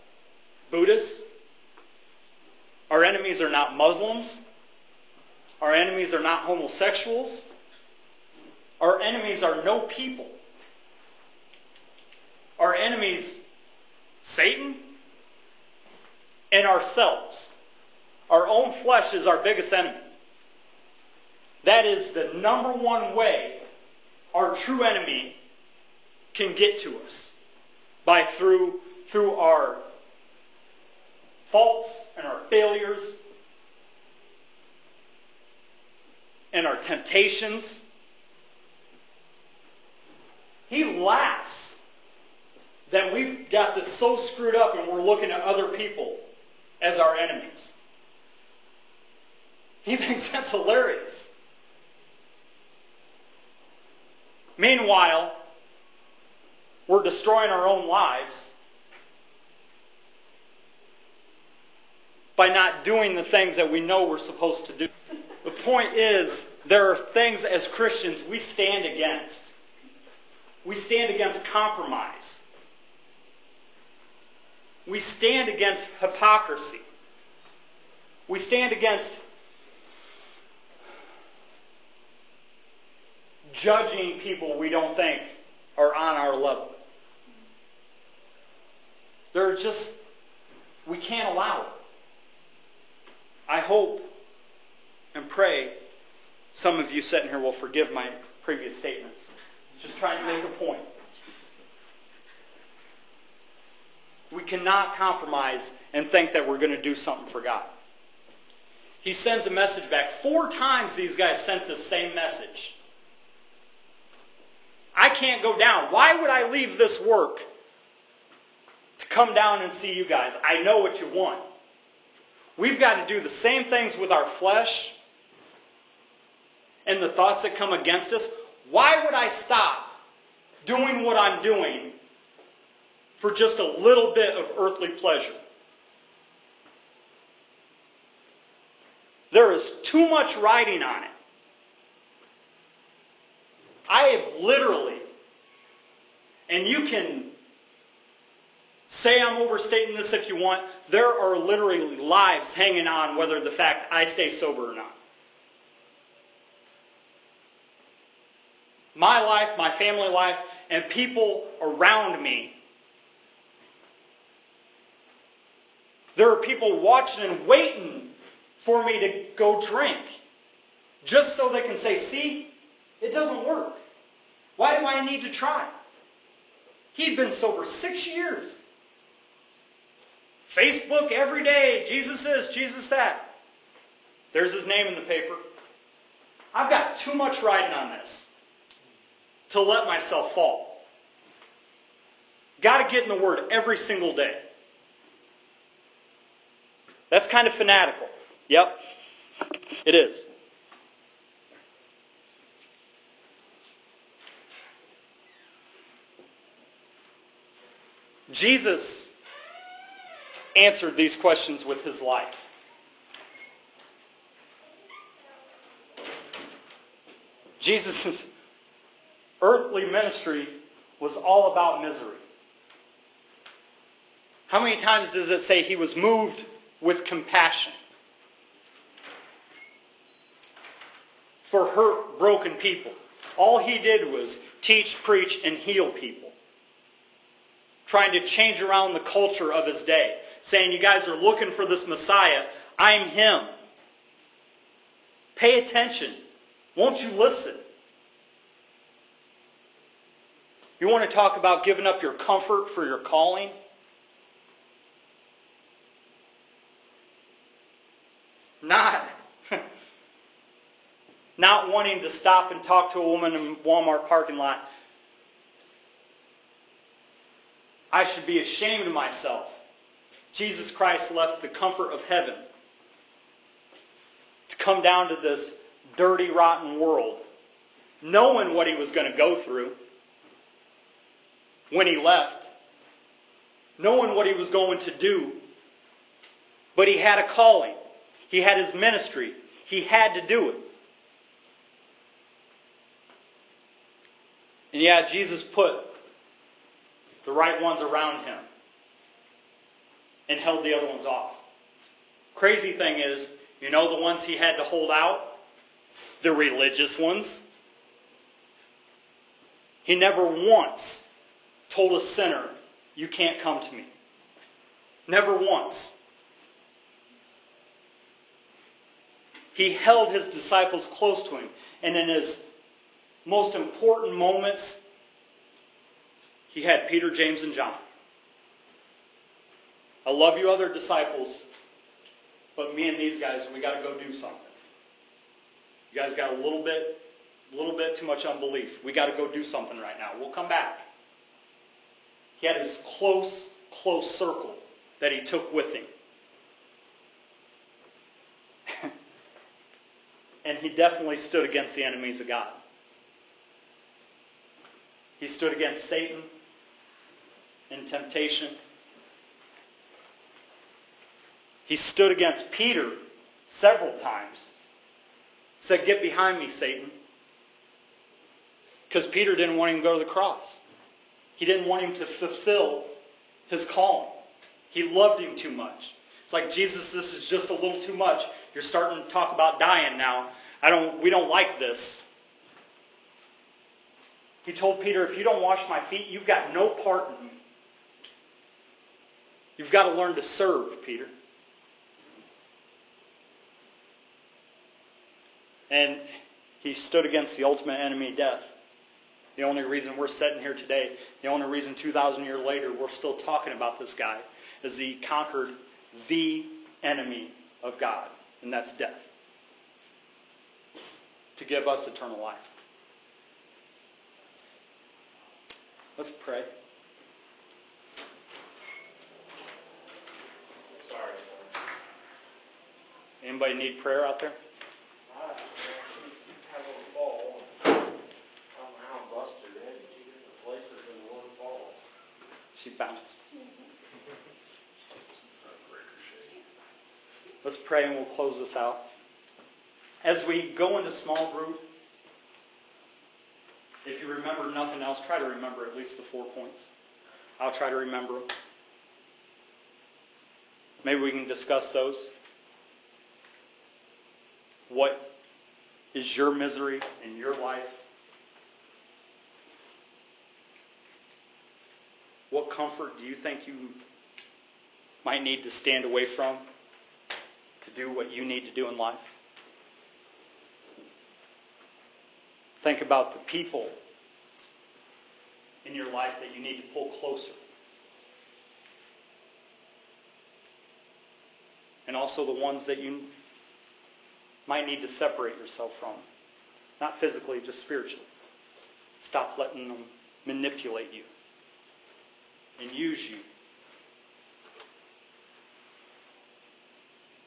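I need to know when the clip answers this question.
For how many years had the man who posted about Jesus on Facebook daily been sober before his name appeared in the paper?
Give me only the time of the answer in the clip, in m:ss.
2:57.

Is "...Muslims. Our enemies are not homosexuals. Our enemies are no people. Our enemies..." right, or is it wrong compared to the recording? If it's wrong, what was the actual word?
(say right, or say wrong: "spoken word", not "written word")
right.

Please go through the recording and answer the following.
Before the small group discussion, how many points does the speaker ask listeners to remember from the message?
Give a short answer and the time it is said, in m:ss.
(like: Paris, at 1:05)
4, at 7:26.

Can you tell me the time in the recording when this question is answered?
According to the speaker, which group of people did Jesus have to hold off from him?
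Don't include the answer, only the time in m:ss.
5:06.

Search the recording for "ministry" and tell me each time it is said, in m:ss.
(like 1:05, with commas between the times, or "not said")
3:39, 4:48.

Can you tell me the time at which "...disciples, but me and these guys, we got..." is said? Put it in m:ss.
5:30.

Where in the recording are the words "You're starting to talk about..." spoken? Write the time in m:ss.
6:18.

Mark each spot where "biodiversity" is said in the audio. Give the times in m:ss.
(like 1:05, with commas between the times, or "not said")
not said.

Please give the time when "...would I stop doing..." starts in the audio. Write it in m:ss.
2:09.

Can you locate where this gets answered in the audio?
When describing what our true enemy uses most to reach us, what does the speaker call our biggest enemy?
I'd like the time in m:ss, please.
0:18.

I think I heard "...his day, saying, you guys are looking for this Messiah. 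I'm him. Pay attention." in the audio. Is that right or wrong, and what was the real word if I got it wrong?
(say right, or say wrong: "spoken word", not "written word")
right.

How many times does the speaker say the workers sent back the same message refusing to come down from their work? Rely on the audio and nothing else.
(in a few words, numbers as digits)
4.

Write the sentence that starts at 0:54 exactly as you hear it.
Meanwhile, we're destroying our own lives by not doing the things that we know we're supposed to do.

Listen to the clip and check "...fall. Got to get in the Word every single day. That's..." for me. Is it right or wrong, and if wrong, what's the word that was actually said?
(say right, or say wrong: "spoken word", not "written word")
right.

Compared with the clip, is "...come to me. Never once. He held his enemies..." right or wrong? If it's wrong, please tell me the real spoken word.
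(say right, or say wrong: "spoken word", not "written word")
wrong: "disciples", not "enemies".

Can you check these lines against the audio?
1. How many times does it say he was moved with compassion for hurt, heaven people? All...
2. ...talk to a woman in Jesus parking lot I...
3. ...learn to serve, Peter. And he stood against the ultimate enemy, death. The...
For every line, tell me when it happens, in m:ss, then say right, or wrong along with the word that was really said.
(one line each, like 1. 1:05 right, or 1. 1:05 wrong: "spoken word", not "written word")
1. 3:44 wrong: "broken", not "heaven"
2. 4:22 wrong: "Walmart", not "Jesus"
3. 6:29 right.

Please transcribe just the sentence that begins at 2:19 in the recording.
There is too much writing on it.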